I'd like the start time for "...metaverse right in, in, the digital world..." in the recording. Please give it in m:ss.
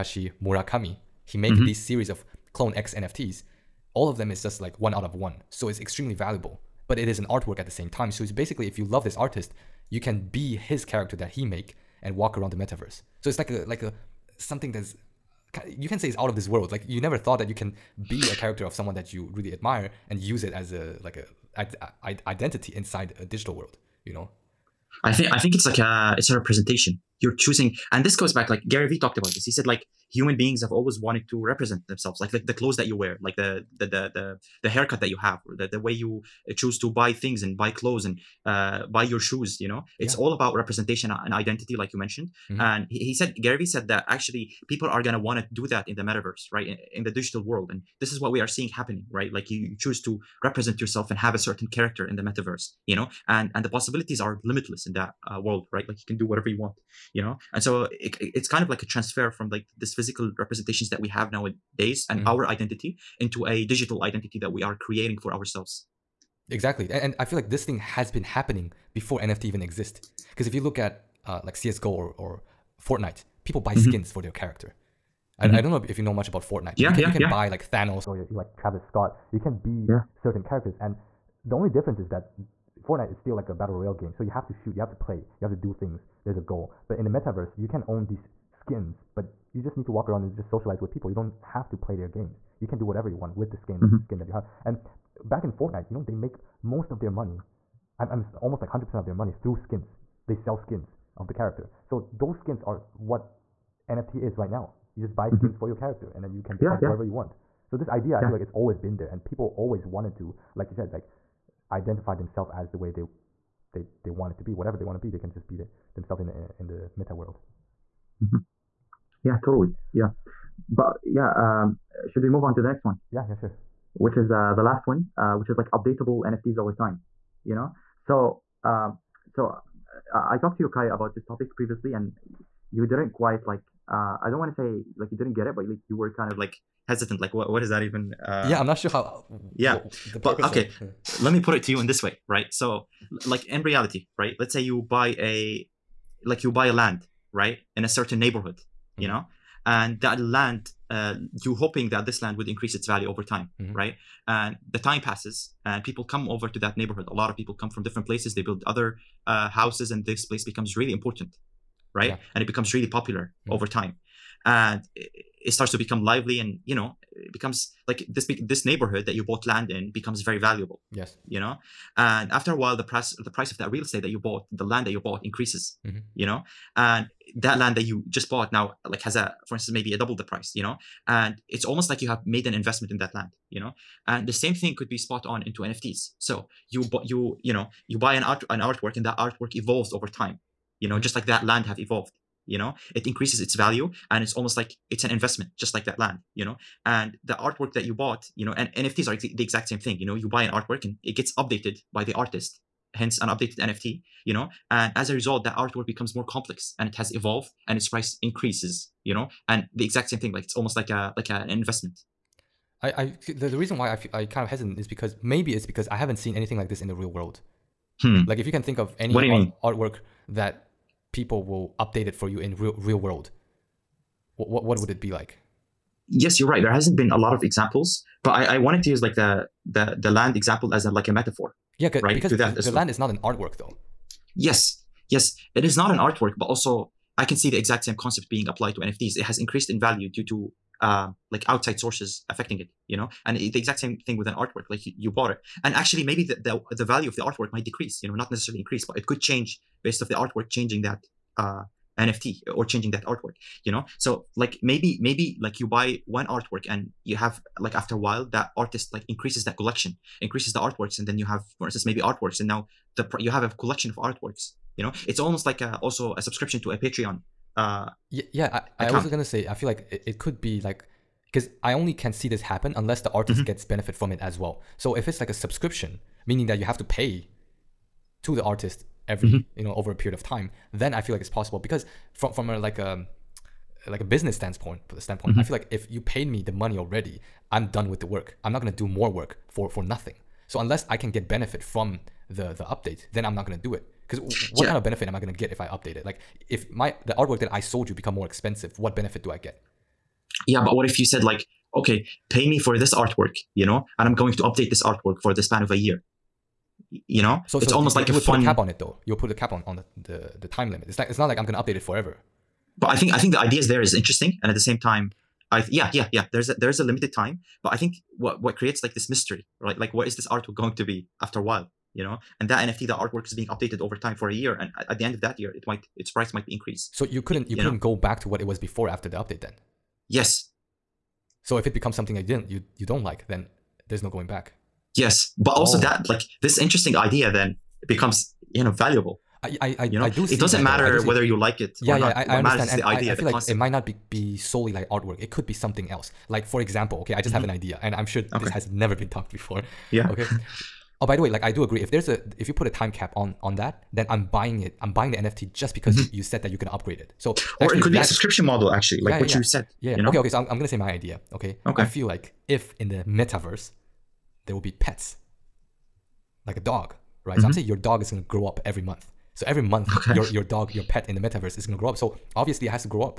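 0:46.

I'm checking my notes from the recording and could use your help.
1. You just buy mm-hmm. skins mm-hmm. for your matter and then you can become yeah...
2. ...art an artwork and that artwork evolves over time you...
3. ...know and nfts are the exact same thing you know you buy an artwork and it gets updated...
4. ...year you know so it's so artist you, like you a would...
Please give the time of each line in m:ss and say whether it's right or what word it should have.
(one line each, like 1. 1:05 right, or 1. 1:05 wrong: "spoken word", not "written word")
1. 1:44 wrong: "character", not "matter"
2. 3:08 right
3. 3:18 right
4. 5:05 wrong: "almost", not "artist".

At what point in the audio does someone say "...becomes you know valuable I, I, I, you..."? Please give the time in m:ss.
5:37.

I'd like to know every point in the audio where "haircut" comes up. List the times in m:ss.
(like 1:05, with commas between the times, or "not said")
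0:34.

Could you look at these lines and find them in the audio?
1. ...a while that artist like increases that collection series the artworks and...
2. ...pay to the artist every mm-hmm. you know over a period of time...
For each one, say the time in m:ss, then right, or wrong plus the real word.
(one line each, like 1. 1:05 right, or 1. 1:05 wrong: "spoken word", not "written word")
1. 4:17 wrong: "increases", not "series"
2. 4:36 right.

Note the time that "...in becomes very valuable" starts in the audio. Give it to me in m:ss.
2:49.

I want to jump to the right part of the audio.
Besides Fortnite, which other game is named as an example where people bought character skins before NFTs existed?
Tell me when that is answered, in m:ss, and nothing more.
1:11.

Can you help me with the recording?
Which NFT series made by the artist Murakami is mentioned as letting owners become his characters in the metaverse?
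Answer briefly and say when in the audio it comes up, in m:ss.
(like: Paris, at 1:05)
CloneX, at 0:02.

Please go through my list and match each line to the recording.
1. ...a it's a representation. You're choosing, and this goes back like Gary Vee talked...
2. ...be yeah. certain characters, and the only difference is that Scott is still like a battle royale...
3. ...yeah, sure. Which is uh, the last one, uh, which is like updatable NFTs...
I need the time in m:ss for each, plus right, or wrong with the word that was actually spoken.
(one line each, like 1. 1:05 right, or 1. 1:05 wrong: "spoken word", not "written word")
1. 0:25 right
2. 1:19 wrong: "Fortnite", not "Scott"
3. 2:03 right.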